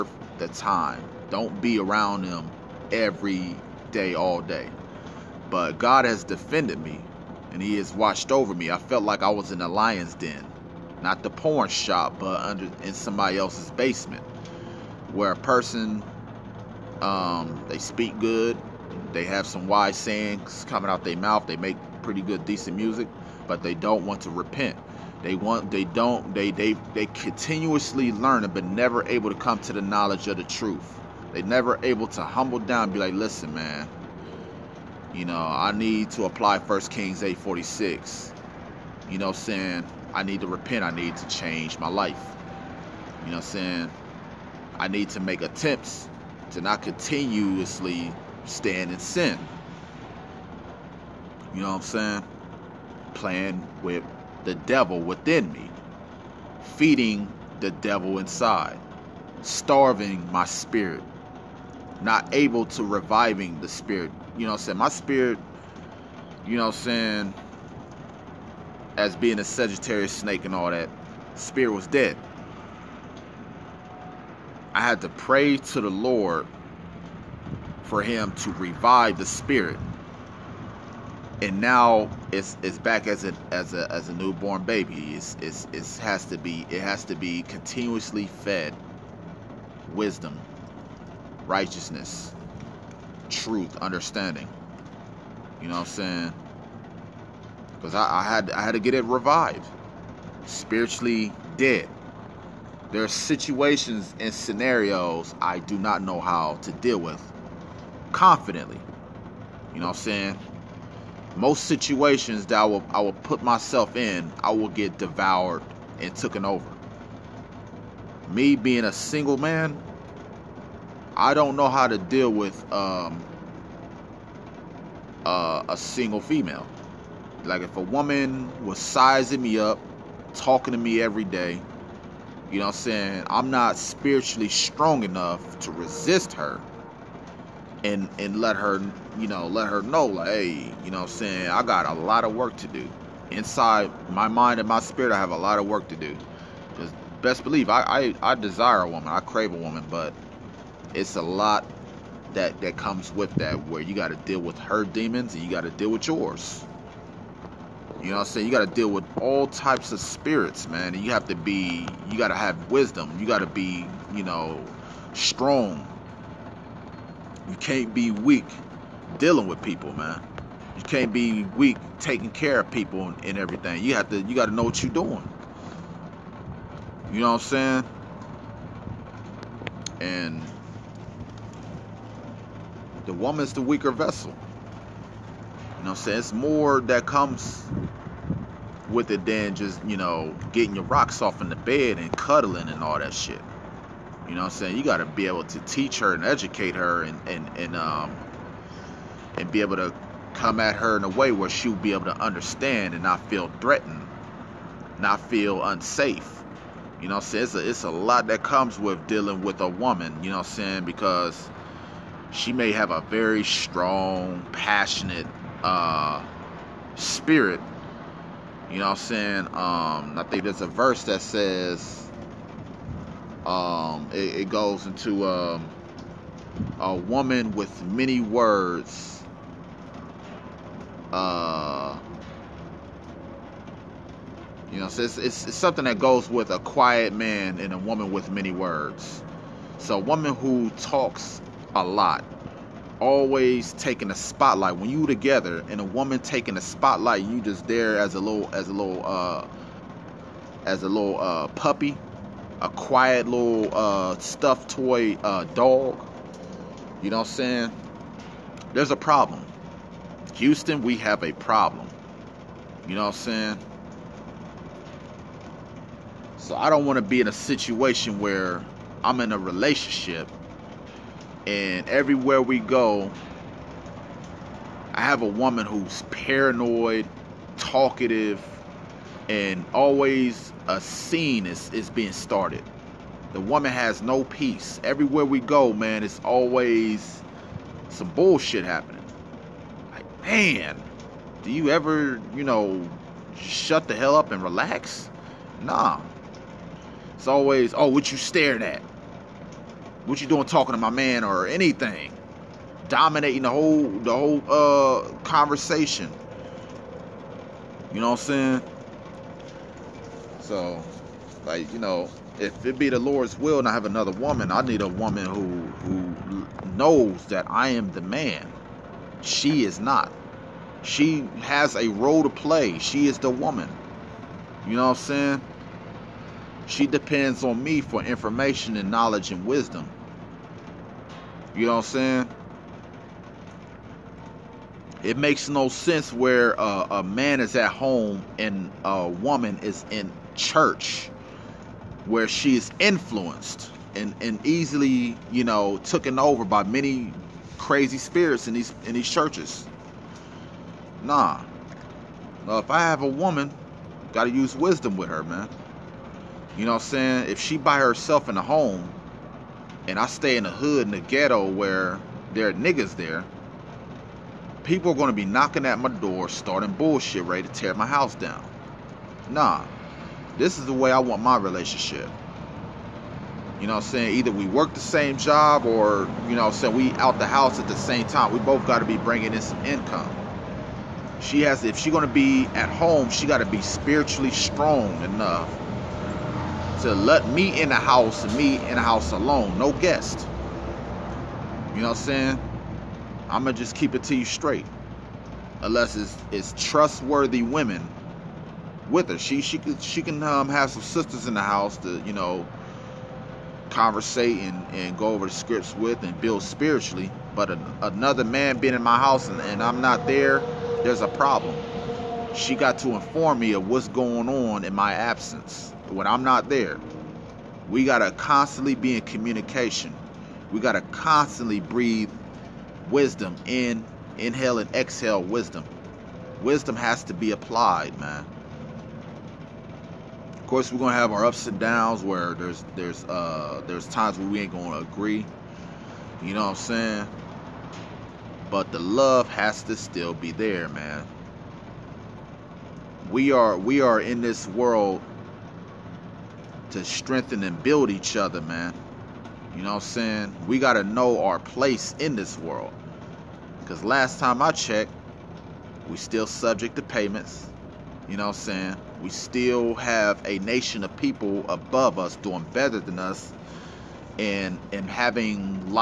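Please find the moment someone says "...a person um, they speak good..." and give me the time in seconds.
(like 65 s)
15 s.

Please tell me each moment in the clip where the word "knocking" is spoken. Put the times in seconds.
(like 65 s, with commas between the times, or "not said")
365 s.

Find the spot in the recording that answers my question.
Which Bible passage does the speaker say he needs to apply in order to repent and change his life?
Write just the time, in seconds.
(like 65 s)
36 s.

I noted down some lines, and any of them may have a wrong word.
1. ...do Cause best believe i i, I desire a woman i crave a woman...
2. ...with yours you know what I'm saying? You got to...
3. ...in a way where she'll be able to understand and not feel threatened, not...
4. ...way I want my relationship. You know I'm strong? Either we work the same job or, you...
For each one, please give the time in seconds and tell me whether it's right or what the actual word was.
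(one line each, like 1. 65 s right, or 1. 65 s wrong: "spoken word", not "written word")
1. 145 s right
2. 155 s right
3. 200 s right
4. 370 s wrong: "saying", not "strong".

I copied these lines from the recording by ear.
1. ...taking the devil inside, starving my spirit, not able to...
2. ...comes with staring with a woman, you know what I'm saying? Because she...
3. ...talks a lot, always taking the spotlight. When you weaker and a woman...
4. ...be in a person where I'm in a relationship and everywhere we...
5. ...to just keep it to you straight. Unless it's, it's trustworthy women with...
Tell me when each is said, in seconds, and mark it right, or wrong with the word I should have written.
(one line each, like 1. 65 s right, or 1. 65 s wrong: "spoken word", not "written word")
1. 56 s wrong: "feeding", not "taking"
2. 208 s wrong: "dealing", not "staring"
3. 240 s wrong: "together", not "weaker"
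4. 267 s wrong: "situation", not "person"
5. 393 s right.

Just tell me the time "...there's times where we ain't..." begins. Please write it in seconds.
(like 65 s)
433 s.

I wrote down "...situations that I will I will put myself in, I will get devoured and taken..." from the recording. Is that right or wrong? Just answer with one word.
right.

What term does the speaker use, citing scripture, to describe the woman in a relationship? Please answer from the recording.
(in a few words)
the weaker vessel.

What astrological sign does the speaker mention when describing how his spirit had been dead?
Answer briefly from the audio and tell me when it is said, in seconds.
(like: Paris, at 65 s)
Sagittarius, at 69 s.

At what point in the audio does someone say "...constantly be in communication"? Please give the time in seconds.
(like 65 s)
418 s.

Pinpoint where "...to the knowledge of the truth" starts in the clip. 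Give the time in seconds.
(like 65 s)
29 s.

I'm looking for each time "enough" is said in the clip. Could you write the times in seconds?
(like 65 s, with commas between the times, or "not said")
135 s, 385 s.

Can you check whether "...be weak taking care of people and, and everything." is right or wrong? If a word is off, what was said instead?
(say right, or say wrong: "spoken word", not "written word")
right.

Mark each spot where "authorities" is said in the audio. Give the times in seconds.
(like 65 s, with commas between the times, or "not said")
not said.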